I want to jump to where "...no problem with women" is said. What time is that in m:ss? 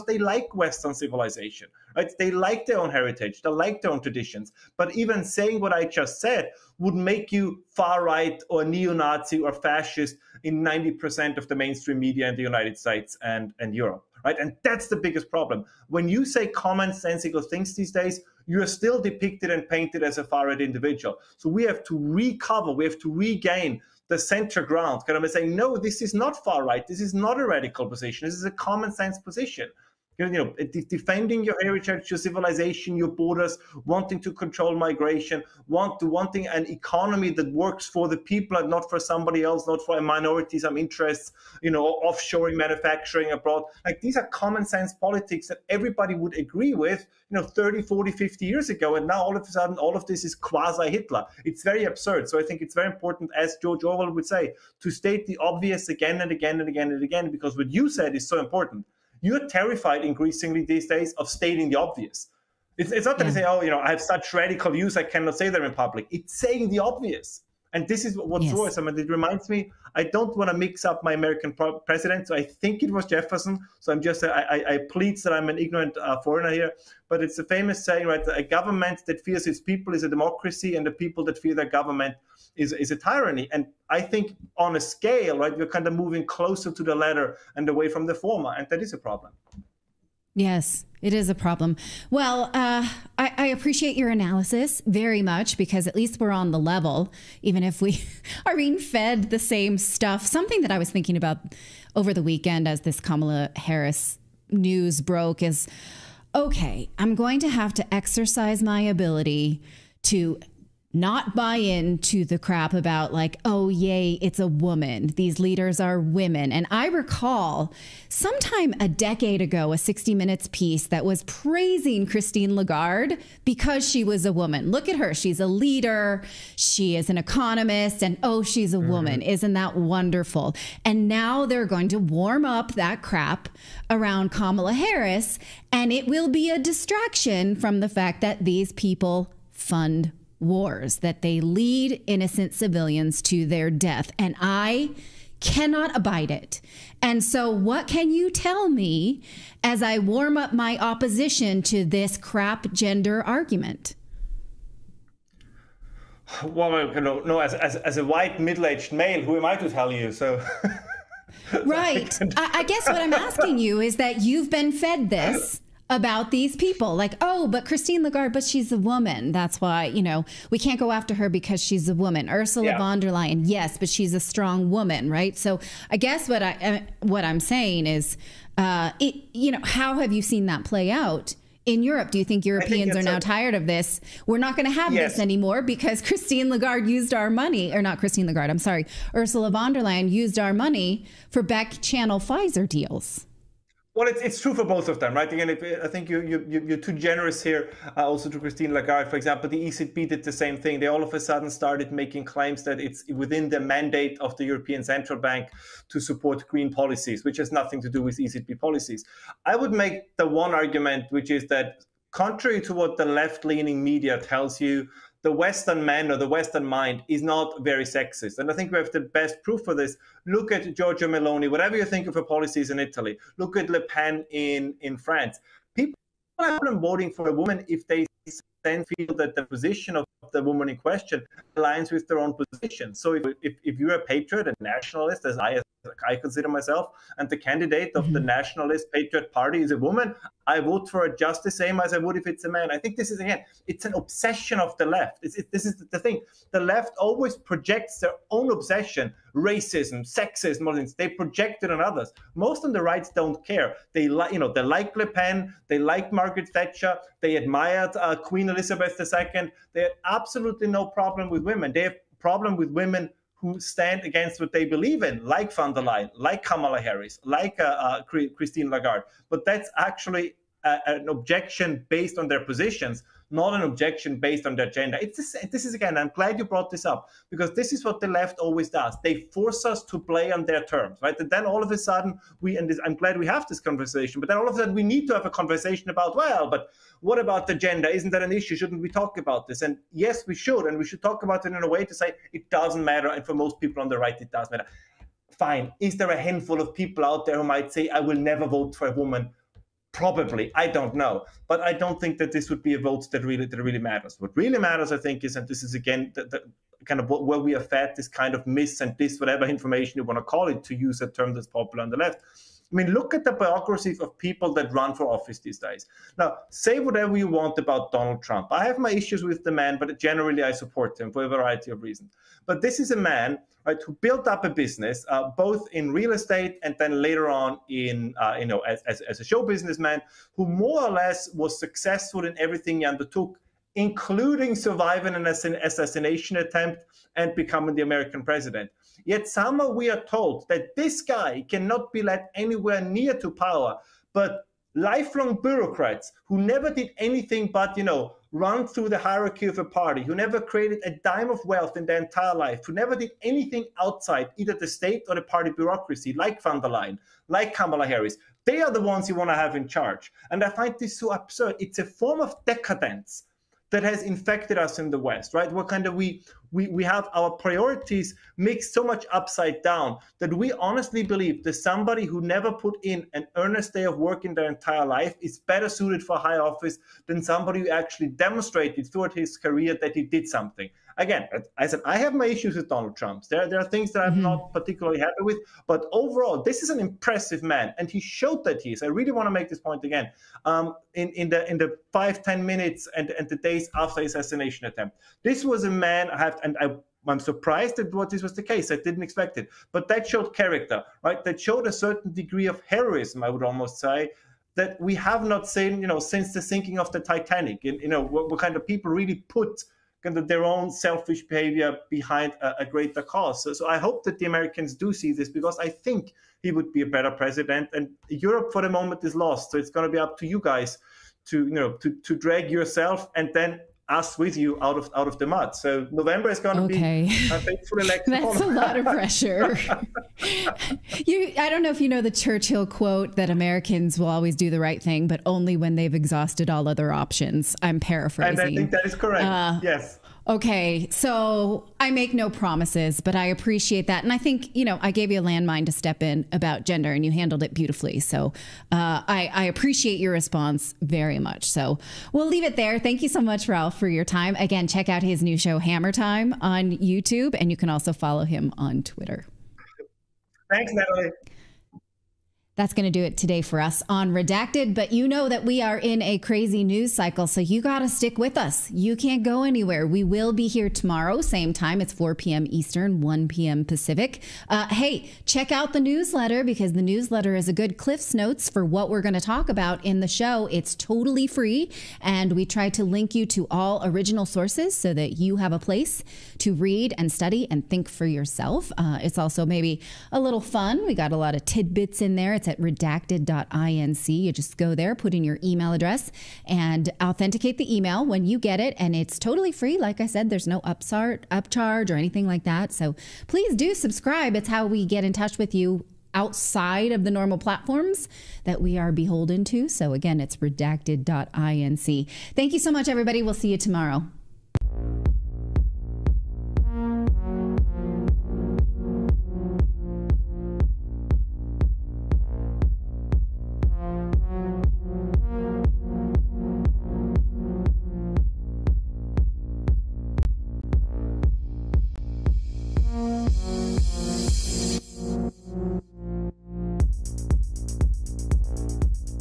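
4:20.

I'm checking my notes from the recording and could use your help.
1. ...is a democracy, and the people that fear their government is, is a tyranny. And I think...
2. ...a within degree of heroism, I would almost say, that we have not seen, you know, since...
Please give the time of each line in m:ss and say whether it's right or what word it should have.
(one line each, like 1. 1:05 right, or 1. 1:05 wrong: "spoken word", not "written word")
1. 1:19 right
2. 6:41 wrong: "certain", not "within".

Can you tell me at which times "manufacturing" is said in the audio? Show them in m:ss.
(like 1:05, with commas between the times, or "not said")
0:42.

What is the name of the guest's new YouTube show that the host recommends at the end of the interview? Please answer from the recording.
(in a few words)
Hammer Time.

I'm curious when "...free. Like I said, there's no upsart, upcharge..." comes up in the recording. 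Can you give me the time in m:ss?
8:19.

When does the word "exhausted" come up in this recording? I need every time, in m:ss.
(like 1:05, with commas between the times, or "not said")
7:15.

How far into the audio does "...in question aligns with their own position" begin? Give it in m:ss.
3:50.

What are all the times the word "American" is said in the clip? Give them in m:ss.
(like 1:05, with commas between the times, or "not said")
1:11, 5:37, 6:54, 7:13.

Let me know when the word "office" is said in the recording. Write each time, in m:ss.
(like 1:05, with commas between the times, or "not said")
5:15, 6:16.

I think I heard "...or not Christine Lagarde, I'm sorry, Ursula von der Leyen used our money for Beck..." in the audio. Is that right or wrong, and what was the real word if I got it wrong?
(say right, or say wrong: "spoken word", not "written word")
right.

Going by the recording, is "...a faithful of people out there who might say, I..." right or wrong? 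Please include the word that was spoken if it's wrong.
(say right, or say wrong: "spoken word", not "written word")
wrong: "handful", not "faithful".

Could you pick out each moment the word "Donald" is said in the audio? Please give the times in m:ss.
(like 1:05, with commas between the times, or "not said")
5:17, 6:22.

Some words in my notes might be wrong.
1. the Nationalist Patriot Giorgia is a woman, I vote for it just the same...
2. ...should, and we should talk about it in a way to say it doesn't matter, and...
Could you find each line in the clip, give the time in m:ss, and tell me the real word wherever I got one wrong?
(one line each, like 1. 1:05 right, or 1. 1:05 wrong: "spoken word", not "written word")
1. 3:58 wrong: "Party", not "Giorgia"
2. 4:50 right.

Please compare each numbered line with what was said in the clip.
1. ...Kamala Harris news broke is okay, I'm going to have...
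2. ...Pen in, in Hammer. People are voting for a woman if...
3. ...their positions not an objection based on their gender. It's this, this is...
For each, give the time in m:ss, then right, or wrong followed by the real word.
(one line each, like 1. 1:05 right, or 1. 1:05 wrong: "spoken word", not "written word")
1. 1:42 right
2. 3:43 wrong: "France", not "Hammer"
3. 4:32 right.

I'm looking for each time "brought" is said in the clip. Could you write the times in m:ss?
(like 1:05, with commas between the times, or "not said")
4:36.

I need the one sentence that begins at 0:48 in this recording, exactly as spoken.
And now all of a sudden, all of this is quasi Hitler.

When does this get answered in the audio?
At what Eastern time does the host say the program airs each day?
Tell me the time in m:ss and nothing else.
7:51.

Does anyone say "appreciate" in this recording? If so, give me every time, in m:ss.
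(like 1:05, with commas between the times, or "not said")
1:33, 7:23, 7:29.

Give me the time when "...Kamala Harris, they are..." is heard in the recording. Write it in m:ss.
5:57.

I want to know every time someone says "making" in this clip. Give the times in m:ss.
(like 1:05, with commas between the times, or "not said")
3:21.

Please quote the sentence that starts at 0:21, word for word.
So we have to recover, we have to regain the center ground.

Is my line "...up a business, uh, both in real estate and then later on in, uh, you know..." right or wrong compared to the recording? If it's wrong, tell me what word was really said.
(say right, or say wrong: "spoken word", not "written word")
right.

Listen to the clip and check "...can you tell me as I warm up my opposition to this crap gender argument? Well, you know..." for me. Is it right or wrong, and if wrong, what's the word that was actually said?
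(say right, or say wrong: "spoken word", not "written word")
right.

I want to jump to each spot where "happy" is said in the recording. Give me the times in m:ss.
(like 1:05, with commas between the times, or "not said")
6:24.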